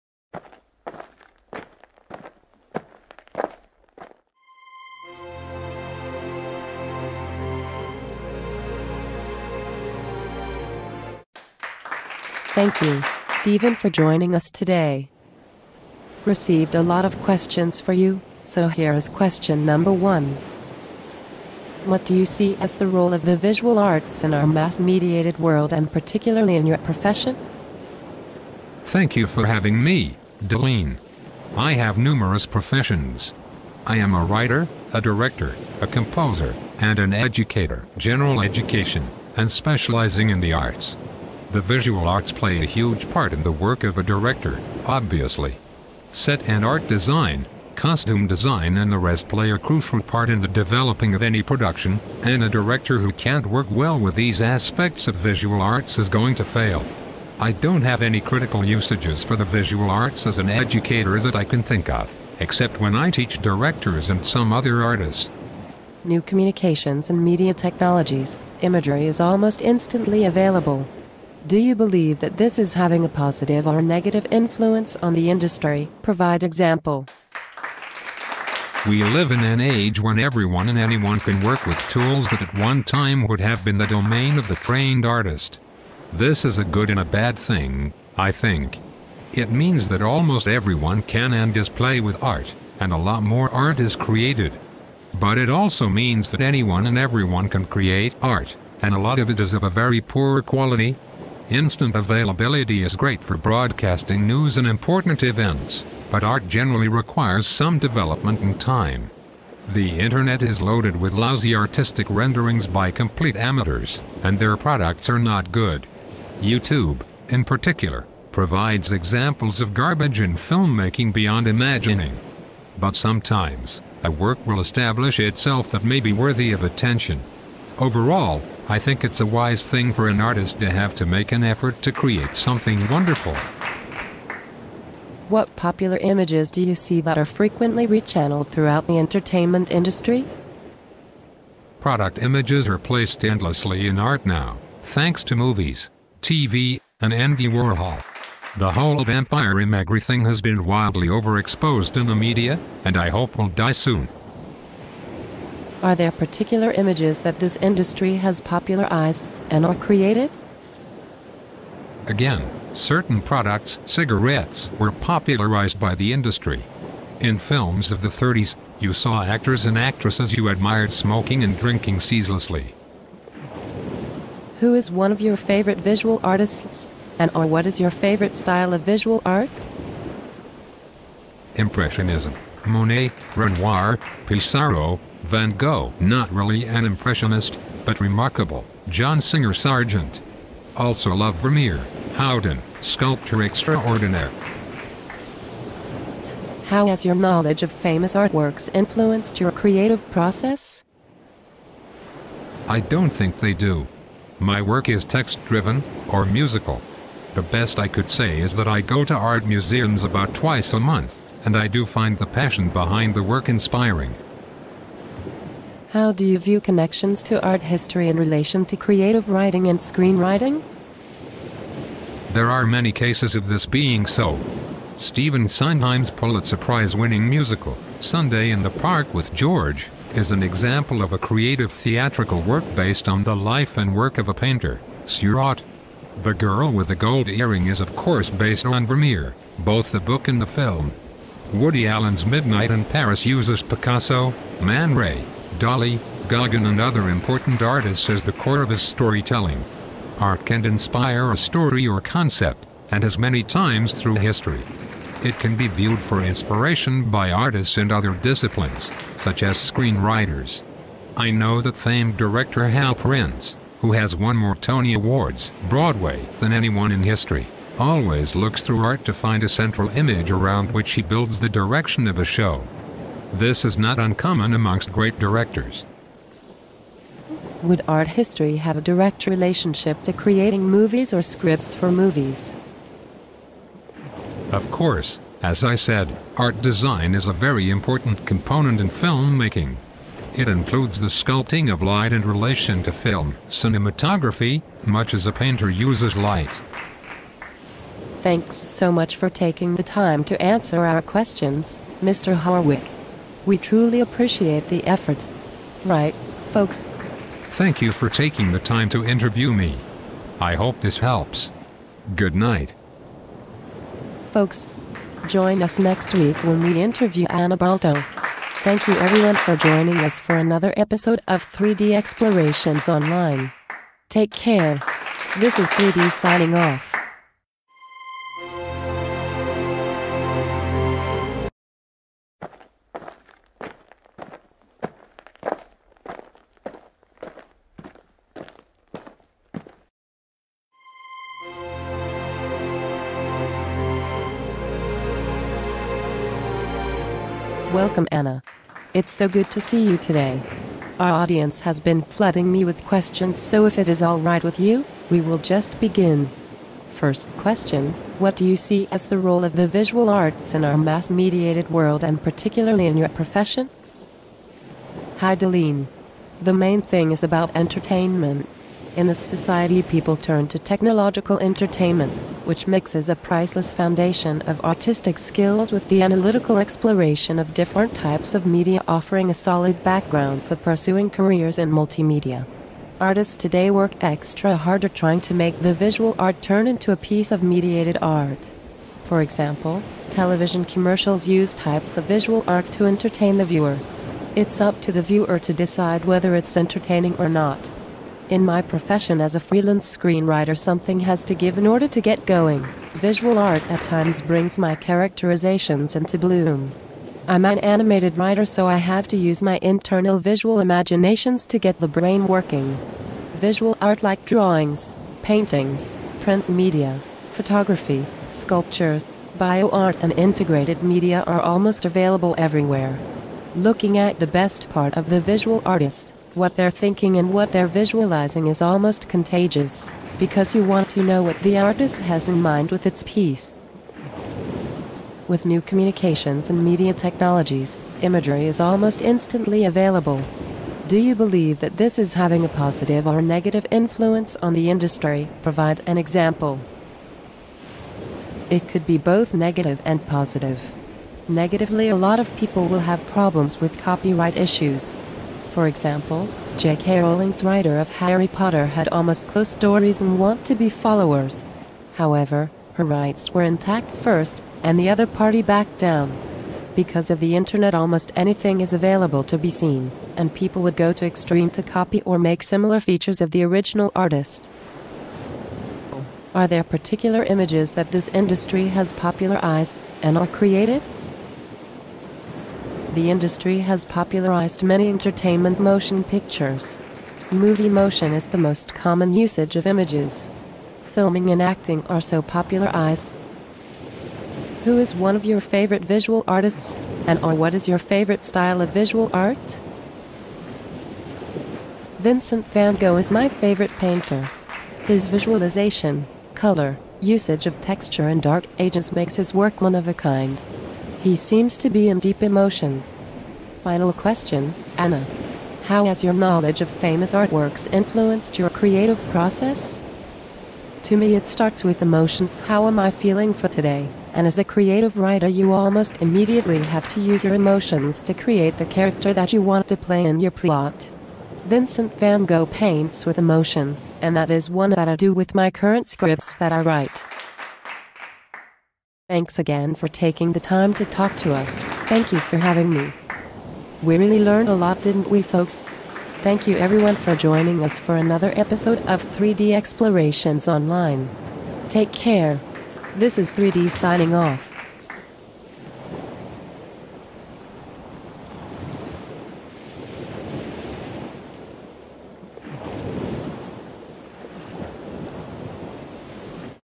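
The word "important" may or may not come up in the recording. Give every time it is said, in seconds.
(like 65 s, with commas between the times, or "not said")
104 s, 247 s, 287 s.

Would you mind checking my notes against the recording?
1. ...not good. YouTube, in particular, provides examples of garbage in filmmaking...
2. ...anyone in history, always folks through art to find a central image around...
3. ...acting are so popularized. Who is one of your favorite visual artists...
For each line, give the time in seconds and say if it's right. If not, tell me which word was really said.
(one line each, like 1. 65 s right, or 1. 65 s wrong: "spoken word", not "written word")
1. 115 s right
2. 266 s wrong: "looks", not "folks"
3. 491 s right.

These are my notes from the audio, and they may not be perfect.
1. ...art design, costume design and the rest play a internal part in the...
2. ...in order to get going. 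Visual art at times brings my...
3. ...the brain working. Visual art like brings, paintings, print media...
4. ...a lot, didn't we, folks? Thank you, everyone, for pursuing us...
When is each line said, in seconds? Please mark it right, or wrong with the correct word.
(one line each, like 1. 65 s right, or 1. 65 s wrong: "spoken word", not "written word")
1. 46 s wrong: "crucial", not "internal"
2. 401 s right
3. 411 s wrong: "drawings", not "brings"
4. 544 s wrong: "joining", not "pursuing".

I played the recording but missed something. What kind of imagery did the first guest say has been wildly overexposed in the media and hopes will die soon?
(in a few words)
Vampire imagery.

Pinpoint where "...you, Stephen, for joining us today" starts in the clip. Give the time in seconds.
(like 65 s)
12 s.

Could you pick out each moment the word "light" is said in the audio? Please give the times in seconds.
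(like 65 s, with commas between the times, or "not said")
291 s, 296 s.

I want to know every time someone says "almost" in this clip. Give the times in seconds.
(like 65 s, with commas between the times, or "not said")
69 s, 90 s, 421 s, 428 s, 438 s, 458 s, 467 s, 525 s.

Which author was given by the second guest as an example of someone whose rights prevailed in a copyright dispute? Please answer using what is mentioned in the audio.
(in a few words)
J.K. Rowling.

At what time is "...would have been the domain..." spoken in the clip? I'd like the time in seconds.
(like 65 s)
83 s.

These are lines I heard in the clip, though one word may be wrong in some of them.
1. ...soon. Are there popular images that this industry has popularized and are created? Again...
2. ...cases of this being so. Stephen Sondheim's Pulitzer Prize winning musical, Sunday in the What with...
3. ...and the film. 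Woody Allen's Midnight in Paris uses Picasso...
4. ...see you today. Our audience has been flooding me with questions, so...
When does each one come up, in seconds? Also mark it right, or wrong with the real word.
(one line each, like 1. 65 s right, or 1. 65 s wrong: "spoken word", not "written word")
1. 153 s wrong: "particular", not "popular"
2. 222 s wrong: "Park", not "What"
3. 240 s right
4. 349 s right.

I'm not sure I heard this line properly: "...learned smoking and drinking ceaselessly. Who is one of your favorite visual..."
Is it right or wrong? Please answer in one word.
wrong.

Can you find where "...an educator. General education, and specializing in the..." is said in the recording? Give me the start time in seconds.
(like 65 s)
36 s.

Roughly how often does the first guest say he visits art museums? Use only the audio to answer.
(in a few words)
Twice a month.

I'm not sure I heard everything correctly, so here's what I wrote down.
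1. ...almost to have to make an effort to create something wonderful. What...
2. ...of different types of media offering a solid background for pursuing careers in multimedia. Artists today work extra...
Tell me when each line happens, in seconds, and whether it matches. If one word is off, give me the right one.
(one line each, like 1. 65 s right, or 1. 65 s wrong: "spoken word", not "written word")
1. 130 s wrong: "artist", not "almost"
2. 377 s right.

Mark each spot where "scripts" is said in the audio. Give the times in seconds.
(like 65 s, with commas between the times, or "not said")
281 s, 535 s.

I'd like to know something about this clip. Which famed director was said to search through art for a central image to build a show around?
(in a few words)
Hal Prince.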